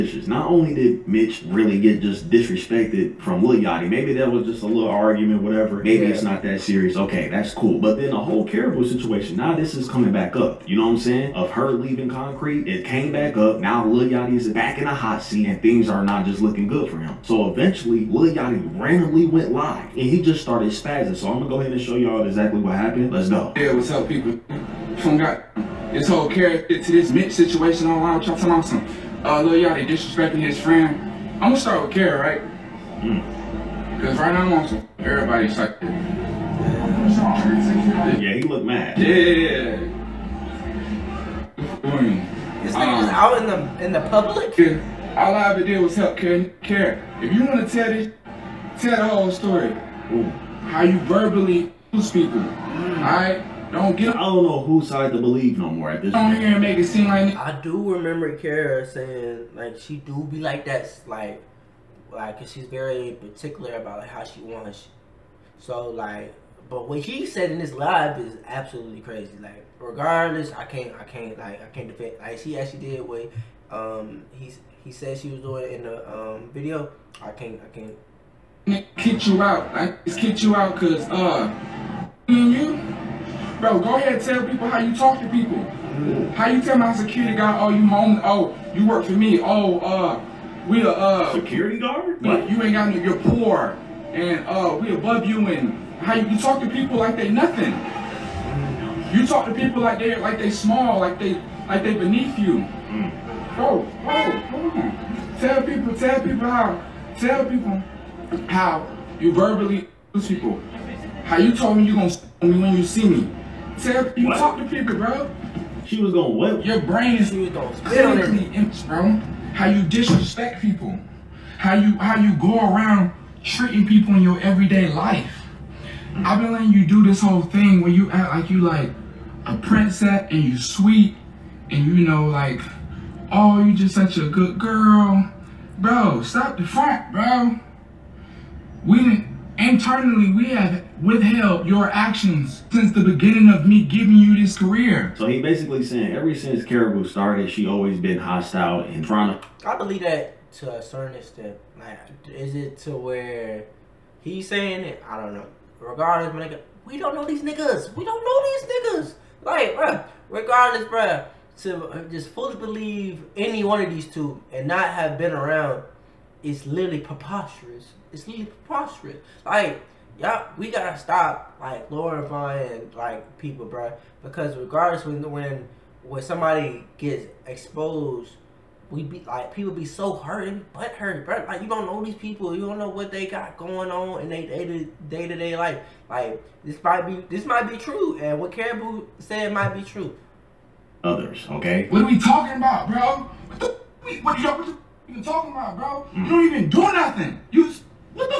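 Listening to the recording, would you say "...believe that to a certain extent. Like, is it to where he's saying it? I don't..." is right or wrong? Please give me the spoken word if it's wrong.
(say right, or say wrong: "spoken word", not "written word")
right.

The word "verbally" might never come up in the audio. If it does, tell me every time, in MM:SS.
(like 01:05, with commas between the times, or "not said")
00:51, 01:49.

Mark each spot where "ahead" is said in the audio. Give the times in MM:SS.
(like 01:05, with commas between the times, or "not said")
00:21, 01:23.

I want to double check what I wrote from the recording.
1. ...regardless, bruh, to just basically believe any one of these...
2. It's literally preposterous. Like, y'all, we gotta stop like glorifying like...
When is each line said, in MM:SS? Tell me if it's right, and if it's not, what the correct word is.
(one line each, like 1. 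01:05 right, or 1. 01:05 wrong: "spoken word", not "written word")
1. 02:40 wrong: "fully", not "basically"
2. 02:48 right.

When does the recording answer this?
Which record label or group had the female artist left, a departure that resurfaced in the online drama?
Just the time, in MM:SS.
00:12.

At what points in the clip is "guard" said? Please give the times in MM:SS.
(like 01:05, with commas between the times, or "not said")
01:27, 01:31.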